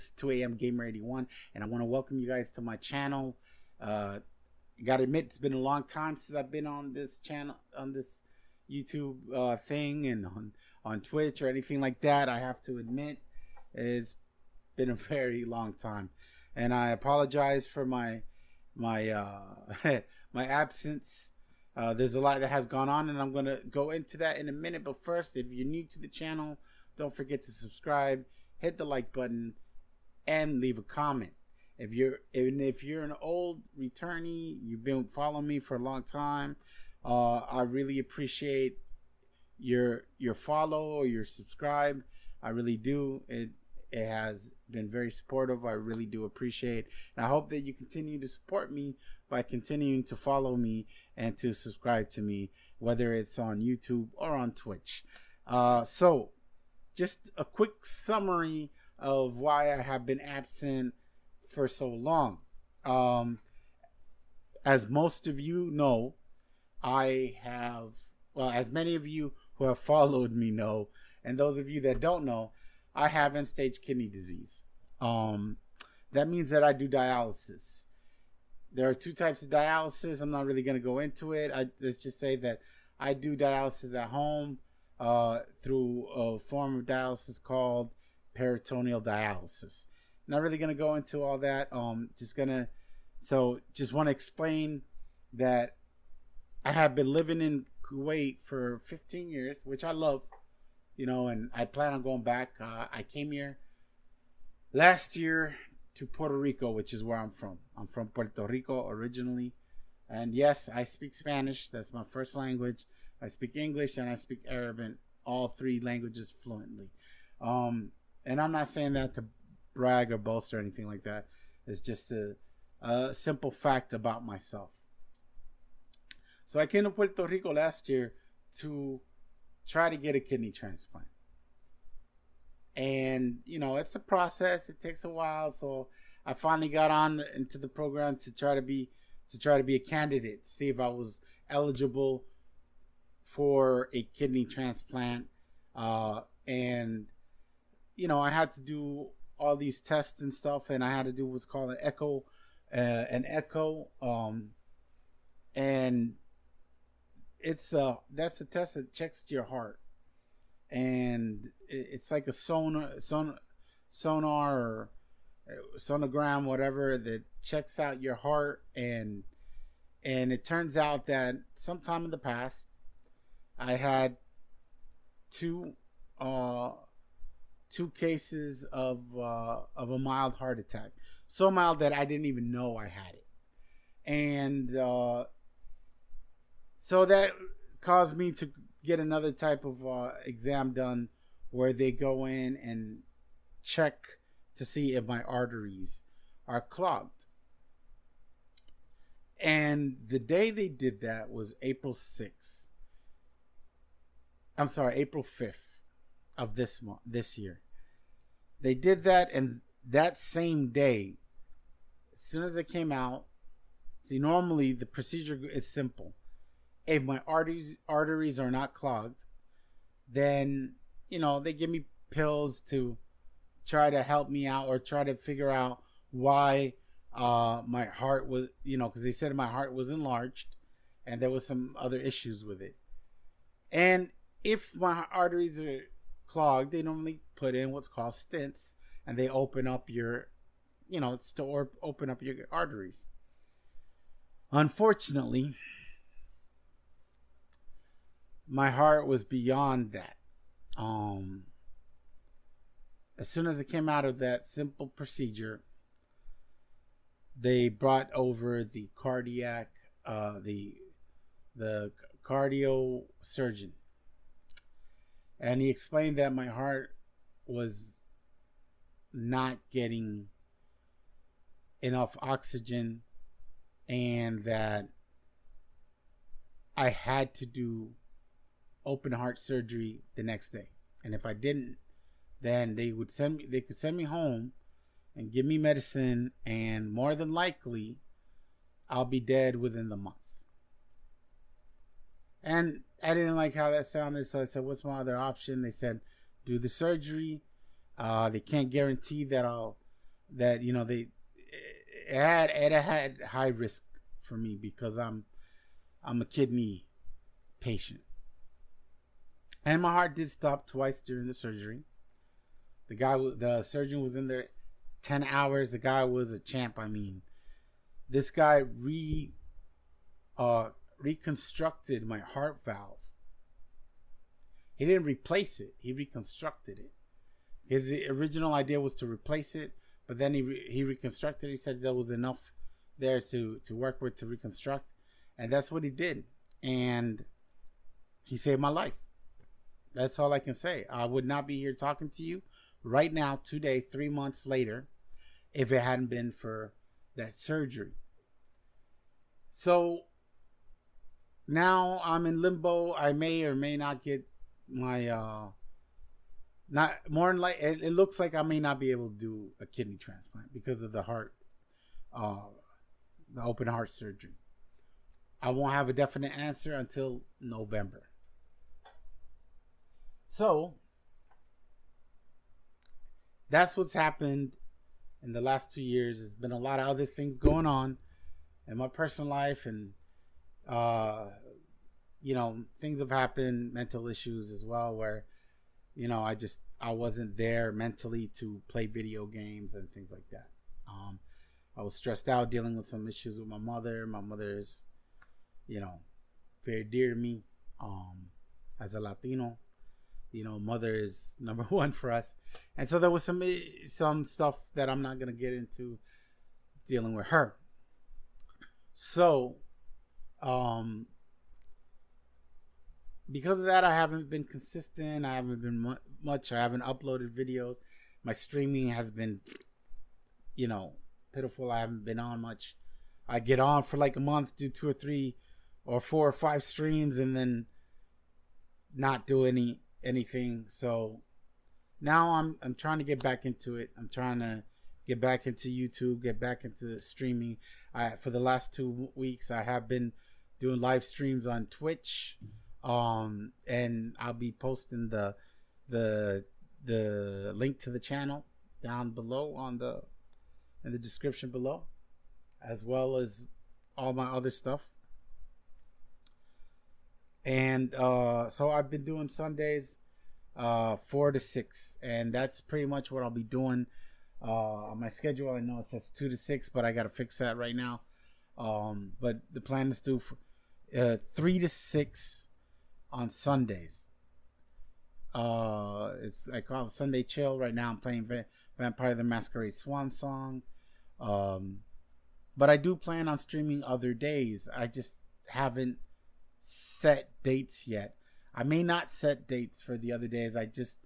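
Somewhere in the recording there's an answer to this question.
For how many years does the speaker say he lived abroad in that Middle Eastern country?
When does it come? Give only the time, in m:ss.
1:38.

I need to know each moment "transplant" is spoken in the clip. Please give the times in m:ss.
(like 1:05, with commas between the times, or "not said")
2:10, 2:24, 5:59.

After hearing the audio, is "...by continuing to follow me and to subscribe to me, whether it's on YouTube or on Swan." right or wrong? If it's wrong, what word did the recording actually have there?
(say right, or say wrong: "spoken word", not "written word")
wrong: "Twitch", not "Swan".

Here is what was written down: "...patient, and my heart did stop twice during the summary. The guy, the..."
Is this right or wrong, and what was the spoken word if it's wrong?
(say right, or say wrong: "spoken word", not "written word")
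wrong: "surgery", not "summary".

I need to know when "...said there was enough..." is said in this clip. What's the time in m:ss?
5:31.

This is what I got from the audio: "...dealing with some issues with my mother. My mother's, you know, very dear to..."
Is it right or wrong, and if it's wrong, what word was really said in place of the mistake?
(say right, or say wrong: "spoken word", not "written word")
right.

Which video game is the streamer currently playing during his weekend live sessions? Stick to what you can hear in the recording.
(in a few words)
Vampire the Masquerade Swan Song.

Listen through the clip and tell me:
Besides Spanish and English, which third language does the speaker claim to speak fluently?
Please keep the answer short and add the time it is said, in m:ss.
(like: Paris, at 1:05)
Arabic, at 1:54.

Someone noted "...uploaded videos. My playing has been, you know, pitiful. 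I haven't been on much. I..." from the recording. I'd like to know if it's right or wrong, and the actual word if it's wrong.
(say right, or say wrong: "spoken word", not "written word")
wrong: "streaming", not "playing".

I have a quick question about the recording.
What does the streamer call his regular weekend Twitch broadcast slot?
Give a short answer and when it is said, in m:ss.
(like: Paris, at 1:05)
Sunday Chill, at 7:56.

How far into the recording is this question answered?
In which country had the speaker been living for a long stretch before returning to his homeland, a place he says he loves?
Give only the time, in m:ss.
1:37.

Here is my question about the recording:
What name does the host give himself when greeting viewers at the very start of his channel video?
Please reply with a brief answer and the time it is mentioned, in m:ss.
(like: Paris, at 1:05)
2AM Gamer81, at 0:00.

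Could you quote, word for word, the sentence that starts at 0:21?
Uh, there's a lot that has gone on, and I'm going to go into that in a minute.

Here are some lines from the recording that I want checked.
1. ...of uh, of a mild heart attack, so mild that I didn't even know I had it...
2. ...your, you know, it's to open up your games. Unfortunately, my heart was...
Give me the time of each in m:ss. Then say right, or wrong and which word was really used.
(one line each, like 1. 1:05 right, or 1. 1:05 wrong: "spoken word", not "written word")
1. 2:58 right
2. 3:59 wrong: "arteries", not "games".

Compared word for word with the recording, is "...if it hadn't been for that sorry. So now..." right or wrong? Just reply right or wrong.
wrong.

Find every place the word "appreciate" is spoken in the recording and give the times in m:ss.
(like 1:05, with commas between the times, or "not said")
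0:37, 0:46.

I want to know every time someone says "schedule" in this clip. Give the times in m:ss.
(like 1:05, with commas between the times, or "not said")
7:45.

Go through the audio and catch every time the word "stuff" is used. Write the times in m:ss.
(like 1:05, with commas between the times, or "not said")
2:30, 6:44, 7:34.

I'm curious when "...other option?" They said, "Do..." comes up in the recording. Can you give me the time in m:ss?
4:55.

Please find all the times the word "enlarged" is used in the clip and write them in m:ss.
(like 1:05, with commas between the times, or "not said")
3:49.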